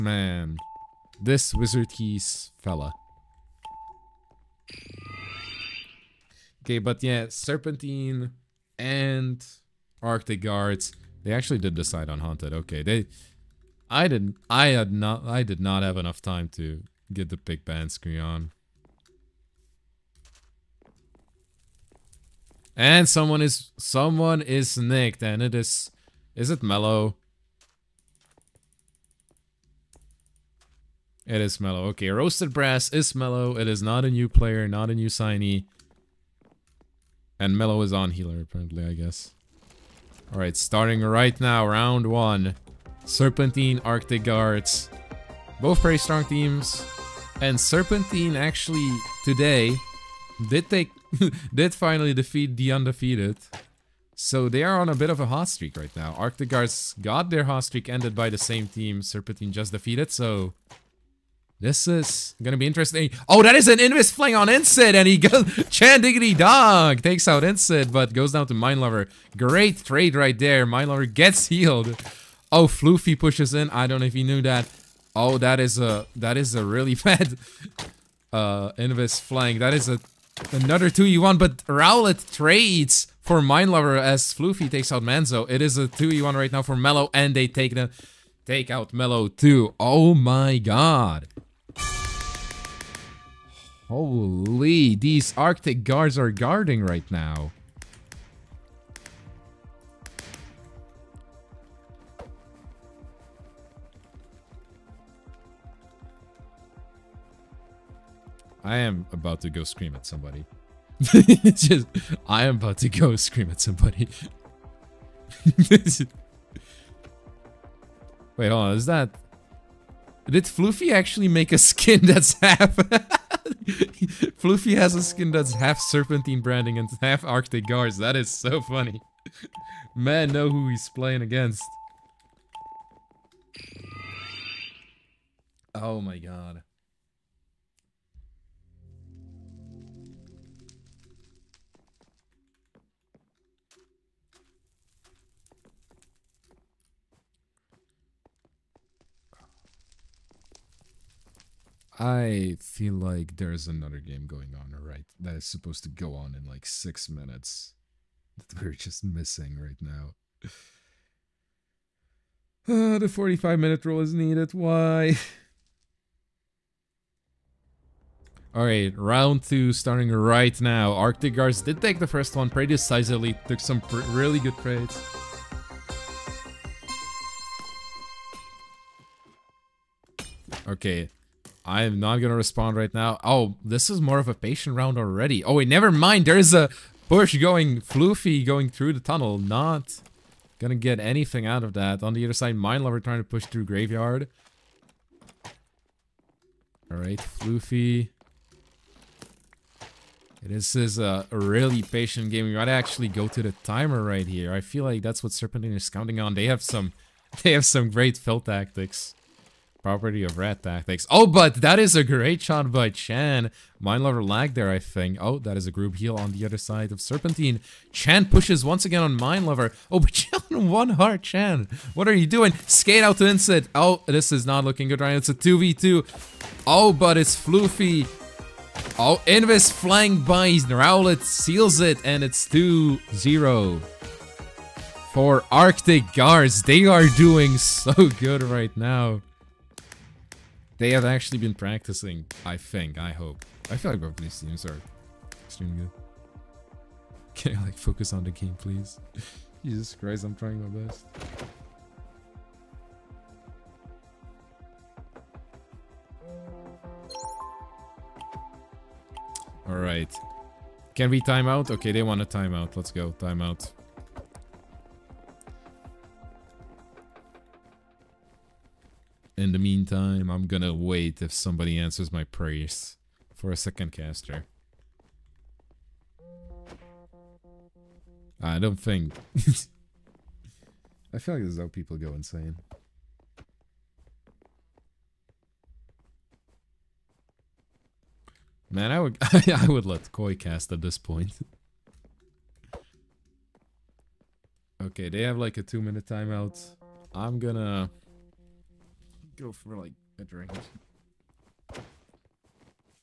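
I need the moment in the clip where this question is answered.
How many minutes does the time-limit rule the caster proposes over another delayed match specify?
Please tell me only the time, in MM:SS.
02:42.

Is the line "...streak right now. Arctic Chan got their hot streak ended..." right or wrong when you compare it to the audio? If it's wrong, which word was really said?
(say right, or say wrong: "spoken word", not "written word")
wrong: "Guards", not "Chan".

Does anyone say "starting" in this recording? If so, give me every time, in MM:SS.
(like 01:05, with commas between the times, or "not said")
00:40, 02:49.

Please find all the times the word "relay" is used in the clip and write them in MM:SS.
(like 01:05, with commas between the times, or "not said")
not said.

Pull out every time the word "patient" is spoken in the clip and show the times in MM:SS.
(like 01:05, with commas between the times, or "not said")
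03:04, 03:21.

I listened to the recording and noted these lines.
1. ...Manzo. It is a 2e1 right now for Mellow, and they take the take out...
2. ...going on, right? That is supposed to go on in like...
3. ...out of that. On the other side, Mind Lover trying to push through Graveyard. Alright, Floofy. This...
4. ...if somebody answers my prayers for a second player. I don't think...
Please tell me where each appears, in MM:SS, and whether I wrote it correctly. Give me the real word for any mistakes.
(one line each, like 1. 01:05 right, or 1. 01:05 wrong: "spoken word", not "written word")
1. 01:25 right
2. 02:34 right
3. 03:11 right
4. 04:31 wrong: "caster", not "player".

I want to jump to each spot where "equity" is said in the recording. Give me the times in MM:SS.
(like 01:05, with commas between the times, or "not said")
not said.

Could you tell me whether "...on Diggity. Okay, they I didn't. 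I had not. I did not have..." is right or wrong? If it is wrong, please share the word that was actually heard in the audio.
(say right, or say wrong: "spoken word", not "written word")
wrong: "Haunted", not "Diggity".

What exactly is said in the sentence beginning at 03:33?
Mind Lover lag there, I think.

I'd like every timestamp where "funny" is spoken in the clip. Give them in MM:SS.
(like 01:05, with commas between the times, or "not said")
02:08.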